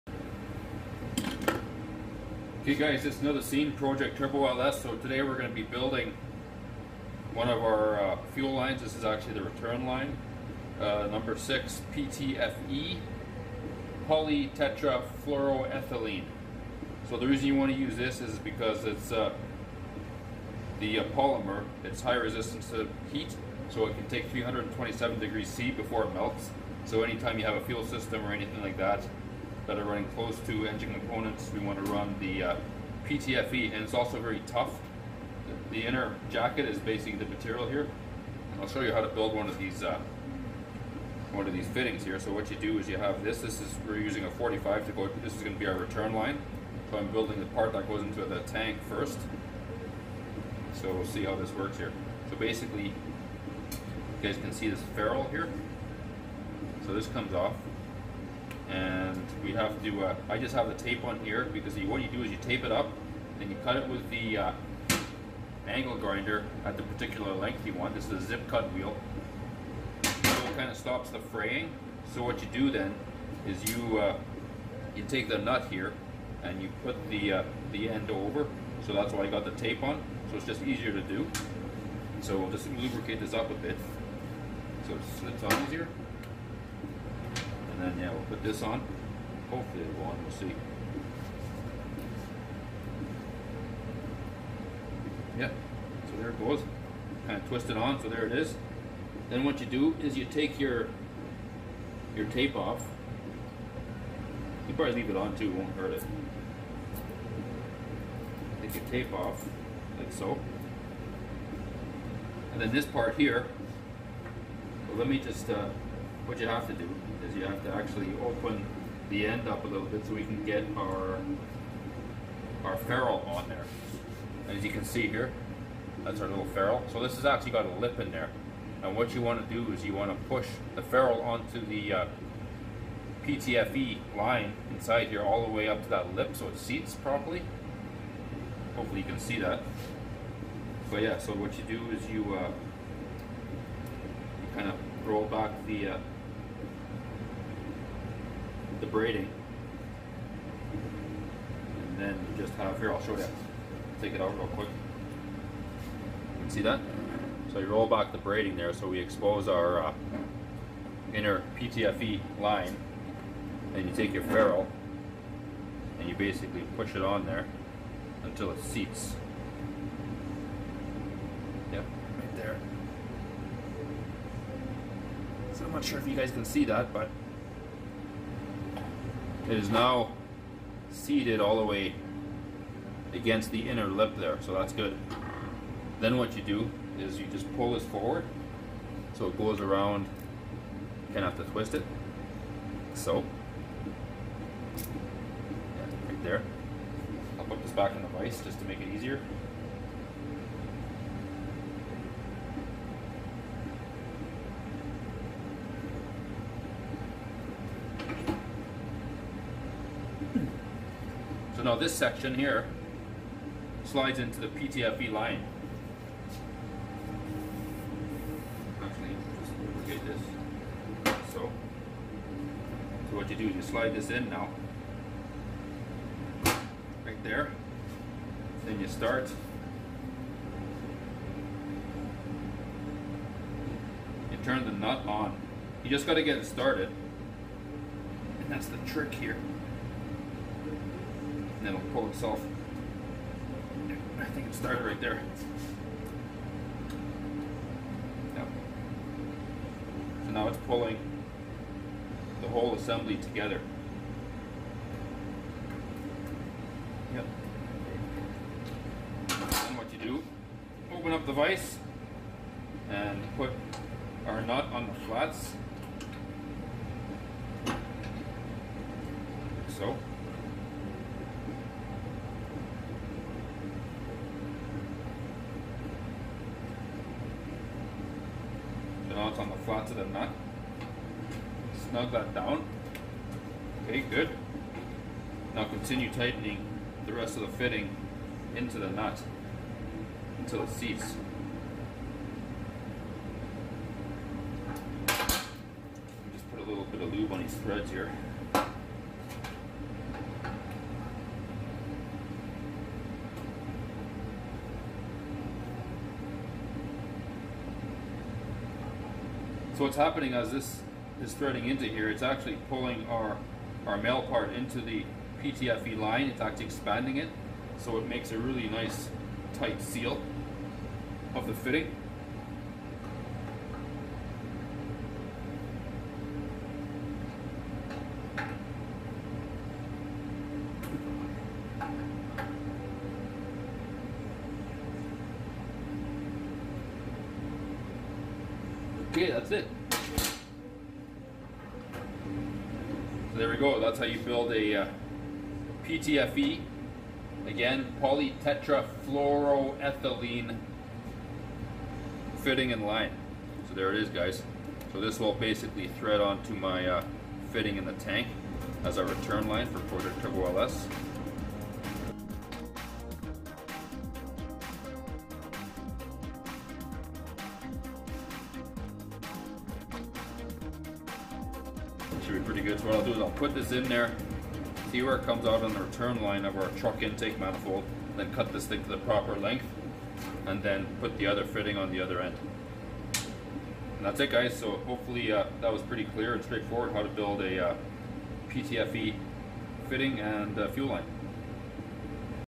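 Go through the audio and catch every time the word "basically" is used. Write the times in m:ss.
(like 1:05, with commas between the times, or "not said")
0:36, 0:52, 2:46, 5:55.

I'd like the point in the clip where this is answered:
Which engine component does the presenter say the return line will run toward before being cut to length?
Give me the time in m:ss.
6:17.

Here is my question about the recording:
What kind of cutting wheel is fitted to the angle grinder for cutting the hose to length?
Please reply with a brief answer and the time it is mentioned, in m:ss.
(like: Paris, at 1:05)
zip cut wheel, at 1:08.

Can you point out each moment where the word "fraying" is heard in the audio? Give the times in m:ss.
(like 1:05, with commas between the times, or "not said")
1:11.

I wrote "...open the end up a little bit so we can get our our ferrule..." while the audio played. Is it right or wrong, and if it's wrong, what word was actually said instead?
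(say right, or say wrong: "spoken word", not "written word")
right.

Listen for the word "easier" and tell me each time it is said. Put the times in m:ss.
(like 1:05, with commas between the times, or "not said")
1:20, 1:25, 3:18.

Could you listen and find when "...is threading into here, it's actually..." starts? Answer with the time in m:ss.
5:11.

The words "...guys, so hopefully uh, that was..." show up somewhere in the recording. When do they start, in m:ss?
6:24.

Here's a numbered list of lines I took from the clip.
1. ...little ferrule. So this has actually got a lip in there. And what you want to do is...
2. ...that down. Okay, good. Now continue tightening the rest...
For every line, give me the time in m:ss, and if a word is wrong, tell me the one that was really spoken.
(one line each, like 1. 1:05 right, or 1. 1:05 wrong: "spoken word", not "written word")
1. 2:06 right
2. 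4:42 right.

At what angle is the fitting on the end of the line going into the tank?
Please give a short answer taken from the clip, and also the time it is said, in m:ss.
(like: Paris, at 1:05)
45, at 0:44.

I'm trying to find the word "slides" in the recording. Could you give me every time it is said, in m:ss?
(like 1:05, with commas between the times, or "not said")
3:33, 3:43.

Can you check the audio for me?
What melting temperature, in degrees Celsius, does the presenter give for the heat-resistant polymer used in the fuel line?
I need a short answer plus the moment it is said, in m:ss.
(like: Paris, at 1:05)
327 degrees C, at 0:24.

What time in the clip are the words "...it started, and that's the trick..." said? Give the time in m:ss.
3:56.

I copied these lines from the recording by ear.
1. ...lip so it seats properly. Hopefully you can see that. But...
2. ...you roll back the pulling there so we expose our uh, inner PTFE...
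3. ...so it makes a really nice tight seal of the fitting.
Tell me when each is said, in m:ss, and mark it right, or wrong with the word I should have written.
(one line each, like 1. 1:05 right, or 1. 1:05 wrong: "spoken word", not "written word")
1. 2:16 right
2. 2:37 wrong: "braiding", not "pulling"
3. 5:17 right.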